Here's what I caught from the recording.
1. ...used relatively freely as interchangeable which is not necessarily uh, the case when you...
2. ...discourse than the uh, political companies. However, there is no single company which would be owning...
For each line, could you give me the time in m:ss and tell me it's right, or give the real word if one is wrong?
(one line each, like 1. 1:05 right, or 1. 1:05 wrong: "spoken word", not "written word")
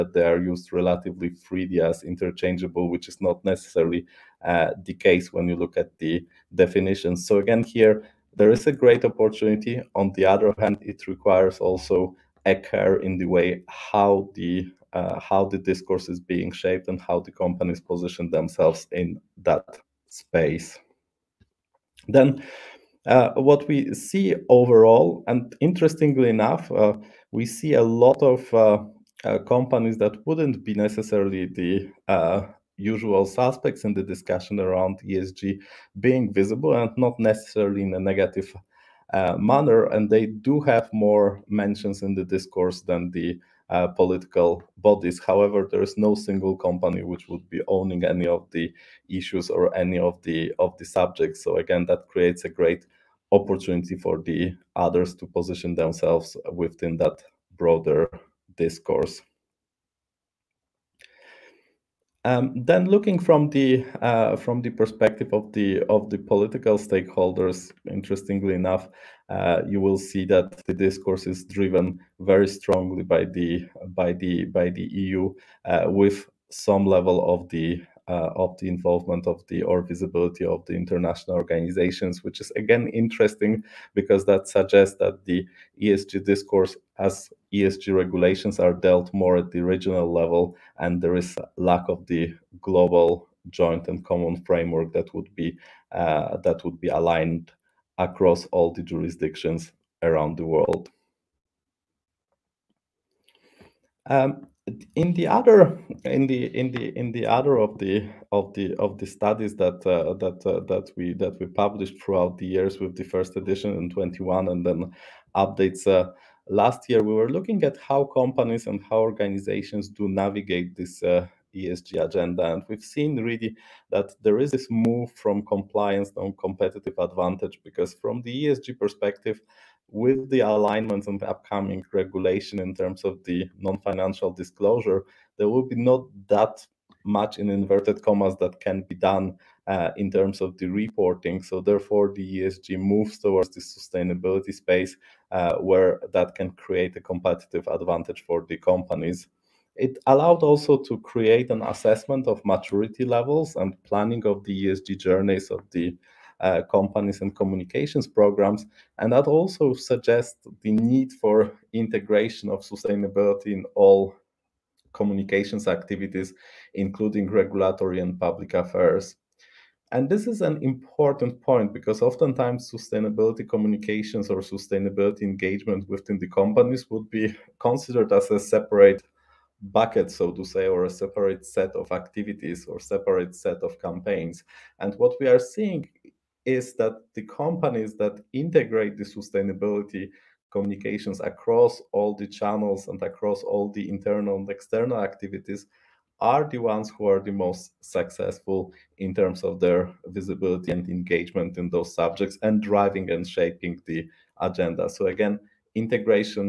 1. 0:00 right
2. 0:42 wrong: "bodies", not "companies".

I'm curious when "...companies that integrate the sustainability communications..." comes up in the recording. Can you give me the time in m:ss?
3:07.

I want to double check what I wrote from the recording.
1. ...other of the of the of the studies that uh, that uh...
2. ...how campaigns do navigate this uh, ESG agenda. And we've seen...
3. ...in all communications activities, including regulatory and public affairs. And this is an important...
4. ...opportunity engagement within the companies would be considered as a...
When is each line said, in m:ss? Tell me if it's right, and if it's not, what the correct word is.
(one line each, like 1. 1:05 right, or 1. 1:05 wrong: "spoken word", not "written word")
1. 1:47 right
2. 1:58 wrong: "organizations", not "campaigns"
3. 2:43 right
4. 2:54 wrong: "sustainability", not "opportunity".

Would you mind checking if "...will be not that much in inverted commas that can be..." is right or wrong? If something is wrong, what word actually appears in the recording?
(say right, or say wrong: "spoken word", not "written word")
right.